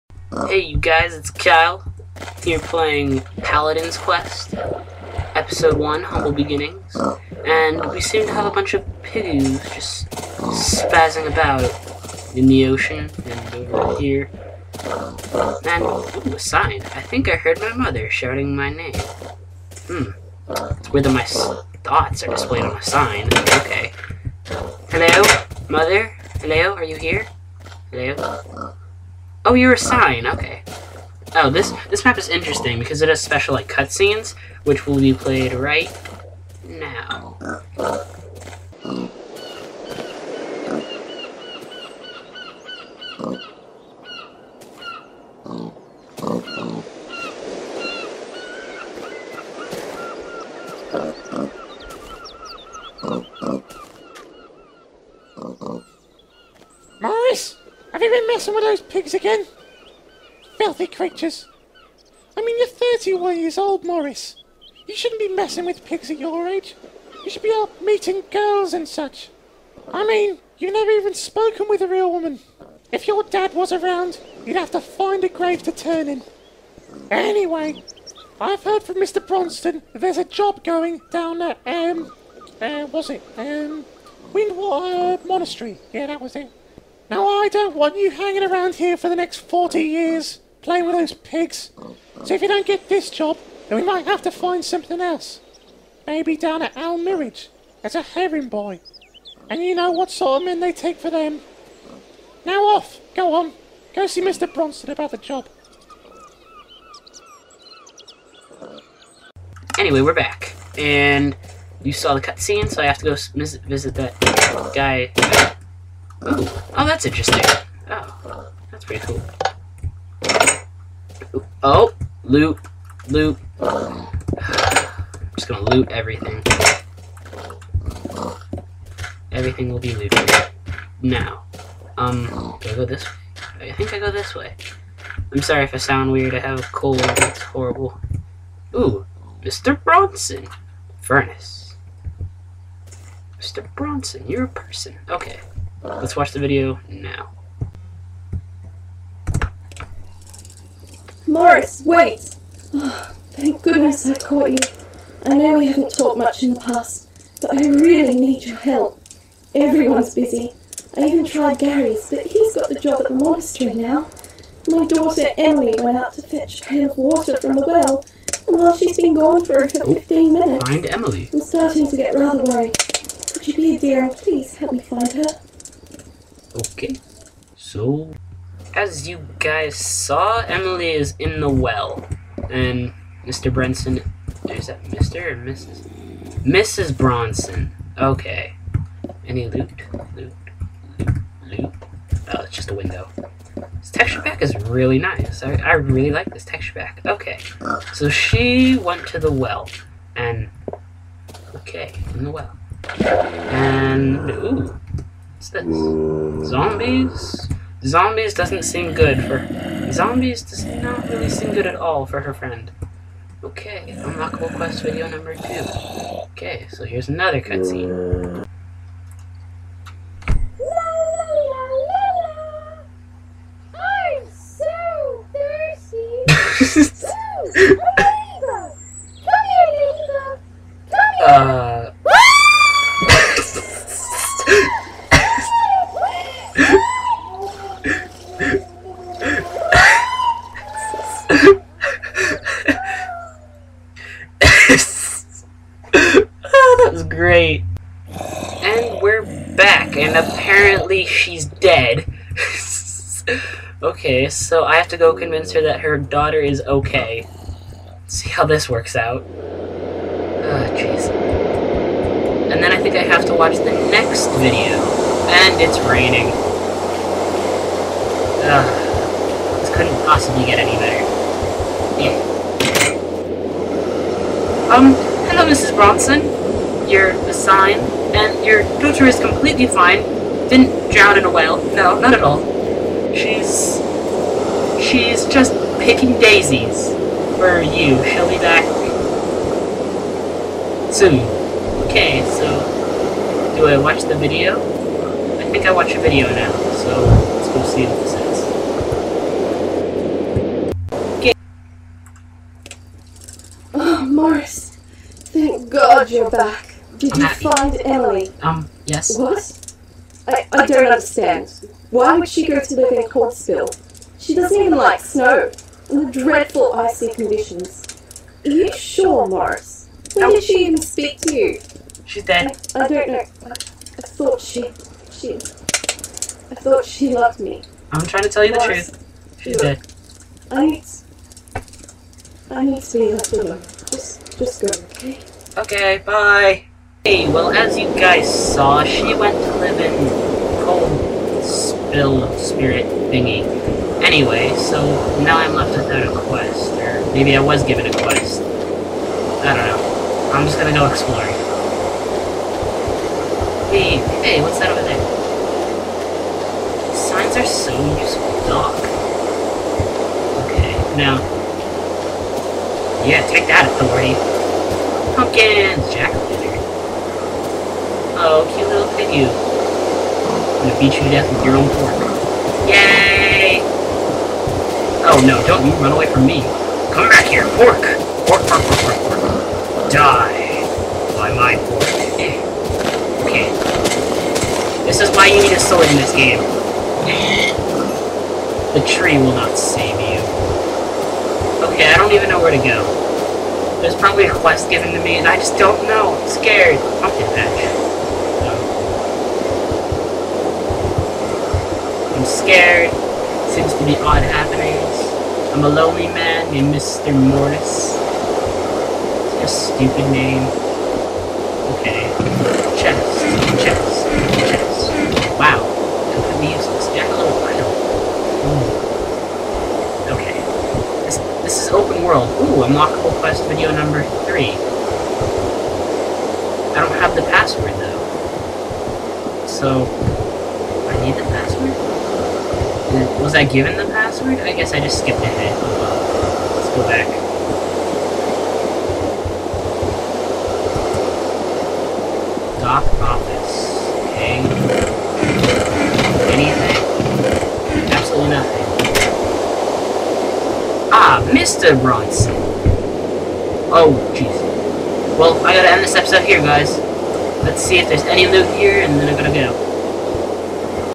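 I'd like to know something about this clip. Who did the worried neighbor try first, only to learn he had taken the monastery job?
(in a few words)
Gary.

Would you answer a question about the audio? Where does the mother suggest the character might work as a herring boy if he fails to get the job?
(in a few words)
Al Mirage.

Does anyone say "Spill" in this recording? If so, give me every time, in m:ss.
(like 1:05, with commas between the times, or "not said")
5:41.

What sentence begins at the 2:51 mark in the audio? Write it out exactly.
I'm starting to get rather worried.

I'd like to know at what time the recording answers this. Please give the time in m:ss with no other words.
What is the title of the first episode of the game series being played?
0:06.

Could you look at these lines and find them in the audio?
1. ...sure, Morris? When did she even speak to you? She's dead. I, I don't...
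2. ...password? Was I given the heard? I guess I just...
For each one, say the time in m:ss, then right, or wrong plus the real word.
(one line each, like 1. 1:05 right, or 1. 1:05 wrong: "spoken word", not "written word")
1. 5:18 right
2. 7:11 wrong: "password", not "heard".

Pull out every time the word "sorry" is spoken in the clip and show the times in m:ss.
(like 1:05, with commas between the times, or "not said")
2:15.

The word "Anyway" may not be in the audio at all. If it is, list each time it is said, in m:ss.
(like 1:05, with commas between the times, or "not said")
1:17, 1:49, 5:44.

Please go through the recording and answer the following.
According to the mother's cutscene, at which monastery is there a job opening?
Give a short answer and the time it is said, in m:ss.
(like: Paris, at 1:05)
Windwater Monastery, at 1:24.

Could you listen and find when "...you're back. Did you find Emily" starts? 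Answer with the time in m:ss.
5:06.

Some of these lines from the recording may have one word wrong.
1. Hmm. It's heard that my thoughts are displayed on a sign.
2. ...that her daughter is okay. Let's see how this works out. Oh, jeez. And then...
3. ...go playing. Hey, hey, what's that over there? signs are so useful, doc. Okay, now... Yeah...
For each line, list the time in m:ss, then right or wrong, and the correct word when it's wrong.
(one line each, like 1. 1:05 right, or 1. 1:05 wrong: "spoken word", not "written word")
1. 0:19 wrong: "weird", not "heard"
2. 4:15 right
3. 5:50 wrong: "exploring", not "playing".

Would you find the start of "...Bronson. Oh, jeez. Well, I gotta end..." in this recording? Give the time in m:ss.
7:31.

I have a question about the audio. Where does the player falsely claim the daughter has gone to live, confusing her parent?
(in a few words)
Corpseville.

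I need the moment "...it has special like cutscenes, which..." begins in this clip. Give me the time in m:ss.
0:33.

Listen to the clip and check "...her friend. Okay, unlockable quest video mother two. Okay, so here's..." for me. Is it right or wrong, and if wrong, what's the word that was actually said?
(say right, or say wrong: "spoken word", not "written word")
wrong: "number", not "mother".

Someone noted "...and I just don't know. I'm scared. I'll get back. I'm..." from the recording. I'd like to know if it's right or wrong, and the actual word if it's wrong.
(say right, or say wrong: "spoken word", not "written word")
right.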